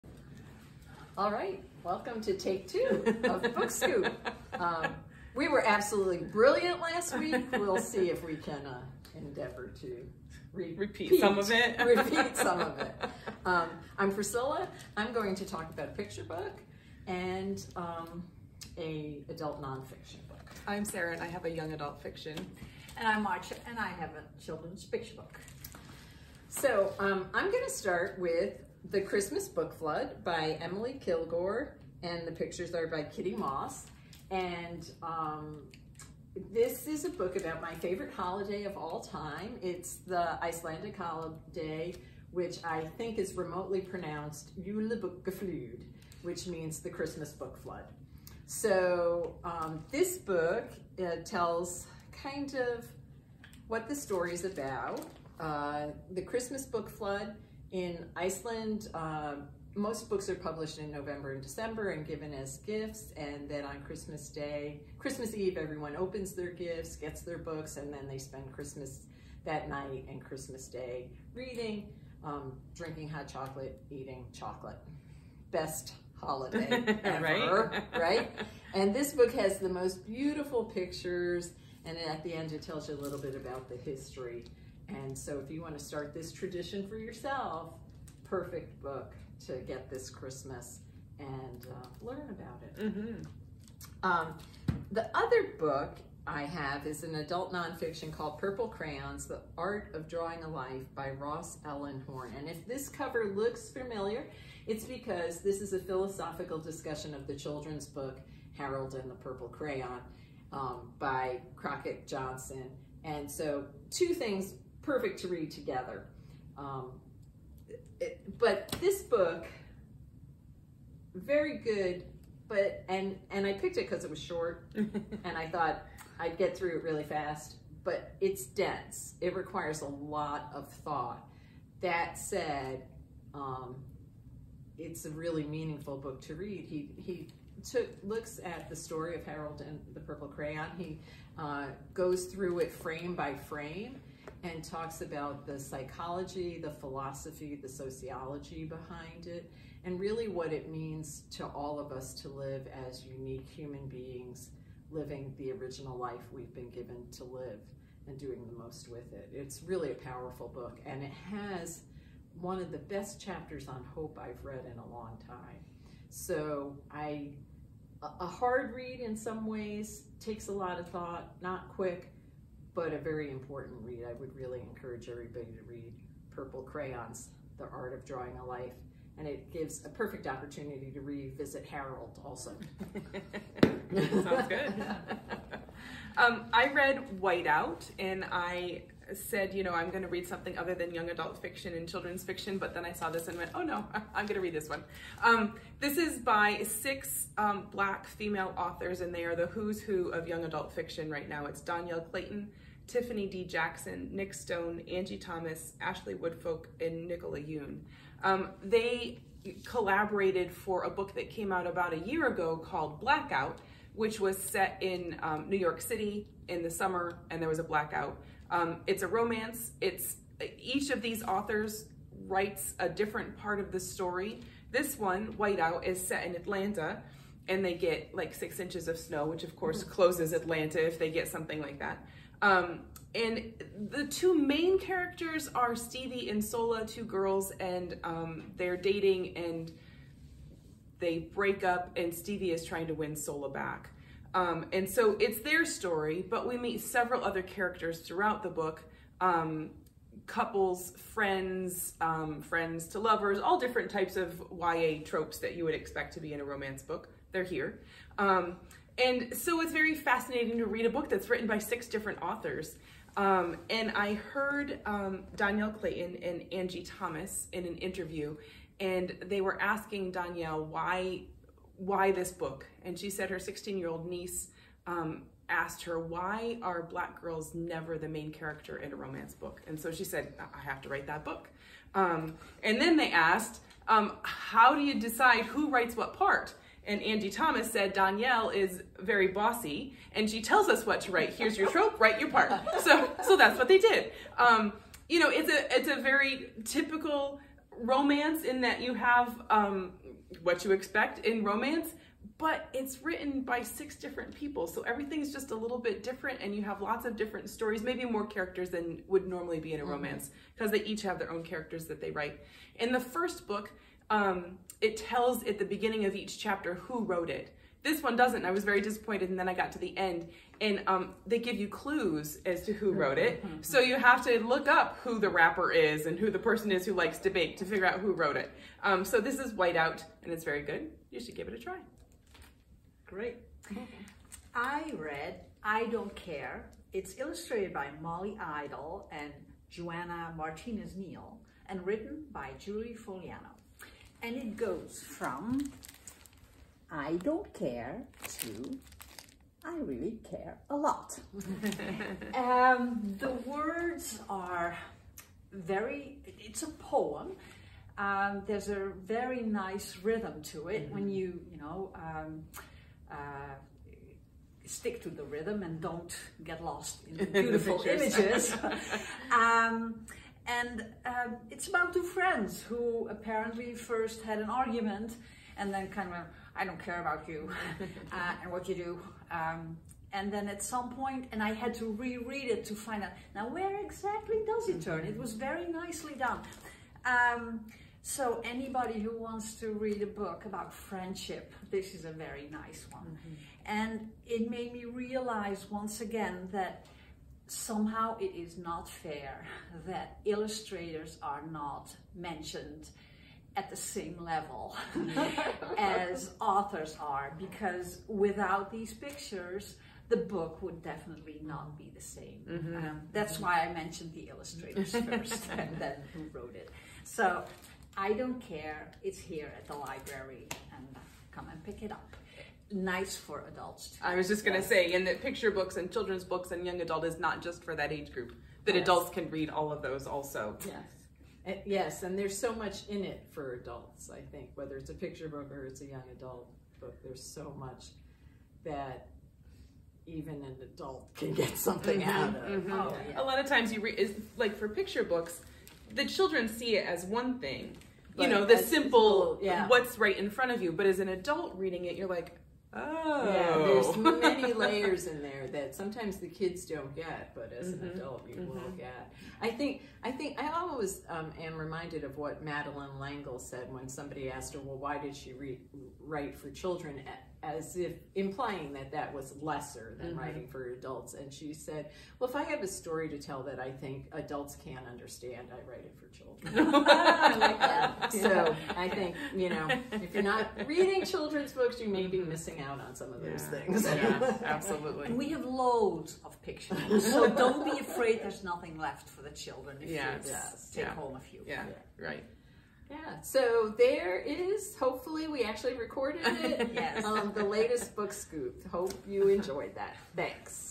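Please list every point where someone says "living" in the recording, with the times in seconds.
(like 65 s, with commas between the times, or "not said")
154 s.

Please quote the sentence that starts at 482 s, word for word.
missing out on some of those things.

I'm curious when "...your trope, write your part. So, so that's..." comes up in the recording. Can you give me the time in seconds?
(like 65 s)
291 s.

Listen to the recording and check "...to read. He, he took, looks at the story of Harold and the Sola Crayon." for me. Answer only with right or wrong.
wrong.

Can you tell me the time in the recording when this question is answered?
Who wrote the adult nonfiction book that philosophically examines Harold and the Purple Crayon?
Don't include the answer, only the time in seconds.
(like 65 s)
101 s.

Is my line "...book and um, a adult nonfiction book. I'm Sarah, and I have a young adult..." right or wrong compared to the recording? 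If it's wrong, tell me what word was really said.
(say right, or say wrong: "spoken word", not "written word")
right.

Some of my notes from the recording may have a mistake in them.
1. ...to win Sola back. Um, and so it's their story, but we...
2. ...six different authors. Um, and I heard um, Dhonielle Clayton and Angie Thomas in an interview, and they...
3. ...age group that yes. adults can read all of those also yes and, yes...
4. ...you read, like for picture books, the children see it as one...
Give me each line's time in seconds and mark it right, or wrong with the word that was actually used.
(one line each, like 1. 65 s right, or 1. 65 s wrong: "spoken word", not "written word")
1. 242 s right
2. 261 s right
3. 427 s right
4. 443 s right.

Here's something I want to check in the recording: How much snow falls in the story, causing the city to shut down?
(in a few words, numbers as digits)
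6 inches.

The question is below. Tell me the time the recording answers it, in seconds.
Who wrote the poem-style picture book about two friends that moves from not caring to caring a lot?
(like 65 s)
342 s.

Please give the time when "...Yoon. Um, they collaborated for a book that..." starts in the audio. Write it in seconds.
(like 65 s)
207 s.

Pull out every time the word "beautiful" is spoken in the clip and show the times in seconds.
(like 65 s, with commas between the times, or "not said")
80 s, 367 s.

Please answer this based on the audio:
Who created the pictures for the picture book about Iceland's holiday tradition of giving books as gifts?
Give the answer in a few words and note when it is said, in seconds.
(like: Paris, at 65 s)
Kitty Moss, at 33 s.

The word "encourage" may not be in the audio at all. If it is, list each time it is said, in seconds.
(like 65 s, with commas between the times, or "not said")
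174 s.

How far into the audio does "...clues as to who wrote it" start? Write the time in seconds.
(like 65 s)
321 s.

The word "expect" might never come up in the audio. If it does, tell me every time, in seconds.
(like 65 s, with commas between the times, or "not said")
255 s, 300 s.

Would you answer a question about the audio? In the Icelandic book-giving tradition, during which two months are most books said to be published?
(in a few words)
November and December.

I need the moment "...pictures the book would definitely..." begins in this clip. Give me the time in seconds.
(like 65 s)
408 s.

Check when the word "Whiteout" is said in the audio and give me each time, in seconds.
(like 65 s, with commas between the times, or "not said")
187 s, 225 s, 329 s.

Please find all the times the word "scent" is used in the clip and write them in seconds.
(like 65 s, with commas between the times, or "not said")
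not said.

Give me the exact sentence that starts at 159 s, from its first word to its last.
It's really a powerful book, and it has one of the best chapters on hope I've read in a long time.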